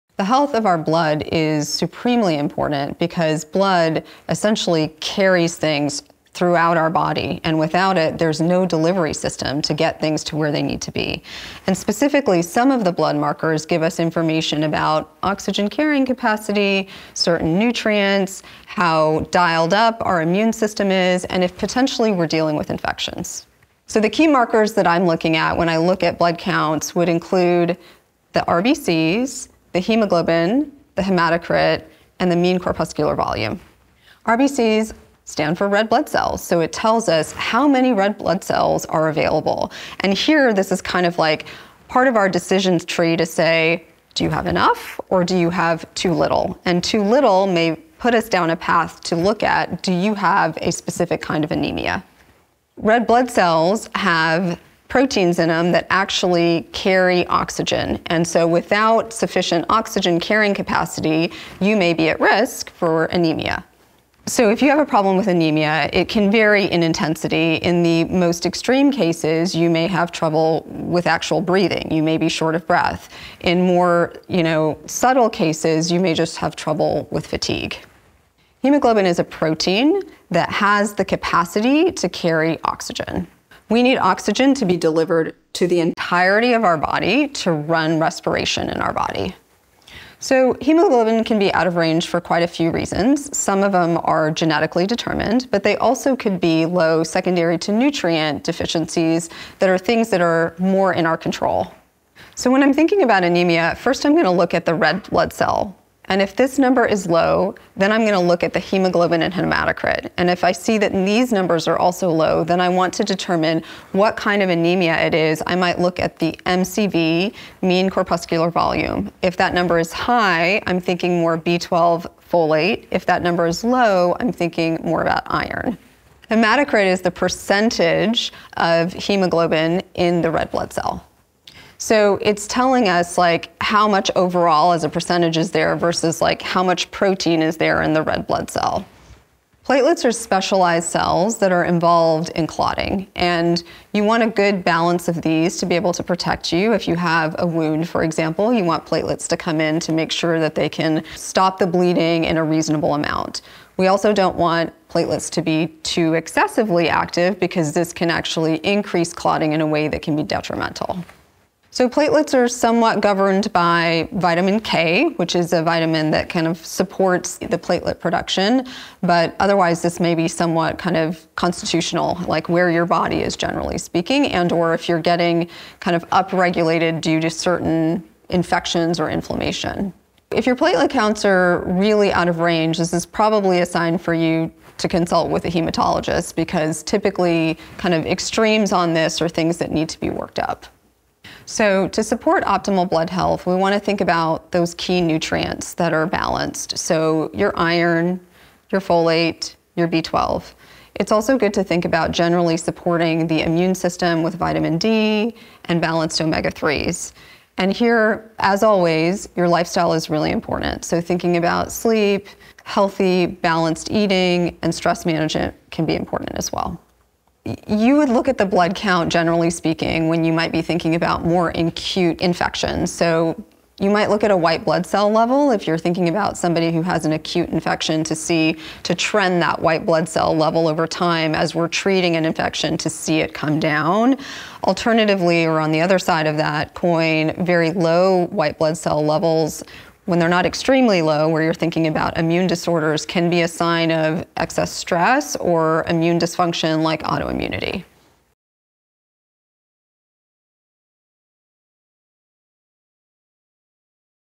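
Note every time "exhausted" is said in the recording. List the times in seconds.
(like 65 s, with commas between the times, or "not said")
not said.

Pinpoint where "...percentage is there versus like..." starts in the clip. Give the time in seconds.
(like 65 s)
134 s.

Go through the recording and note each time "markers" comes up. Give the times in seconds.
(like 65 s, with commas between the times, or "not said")
13 s, 24 s.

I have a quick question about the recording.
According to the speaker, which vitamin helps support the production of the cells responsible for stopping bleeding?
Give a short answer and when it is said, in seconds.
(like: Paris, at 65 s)
Vitamin K, at 164 s.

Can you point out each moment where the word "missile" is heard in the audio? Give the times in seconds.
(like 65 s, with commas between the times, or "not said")
not said.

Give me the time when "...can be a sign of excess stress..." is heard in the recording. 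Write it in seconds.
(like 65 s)
243 s.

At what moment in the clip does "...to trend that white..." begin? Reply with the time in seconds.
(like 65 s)
228 s.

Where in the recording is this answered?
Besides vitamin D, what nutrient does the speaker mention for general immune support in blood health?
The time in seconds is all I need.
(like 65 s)
206 s.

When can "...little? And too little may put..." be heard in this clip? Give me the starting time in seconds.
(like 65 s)
46 s.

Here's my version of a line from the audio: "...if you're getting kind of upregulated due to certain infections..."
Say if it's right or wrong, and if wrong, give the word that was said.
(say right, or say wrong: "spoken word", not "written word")
right.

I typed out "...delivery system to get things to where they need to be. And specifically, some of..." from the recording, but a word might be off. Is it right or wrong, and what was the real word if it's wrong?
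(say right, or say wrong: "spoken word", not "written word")
right.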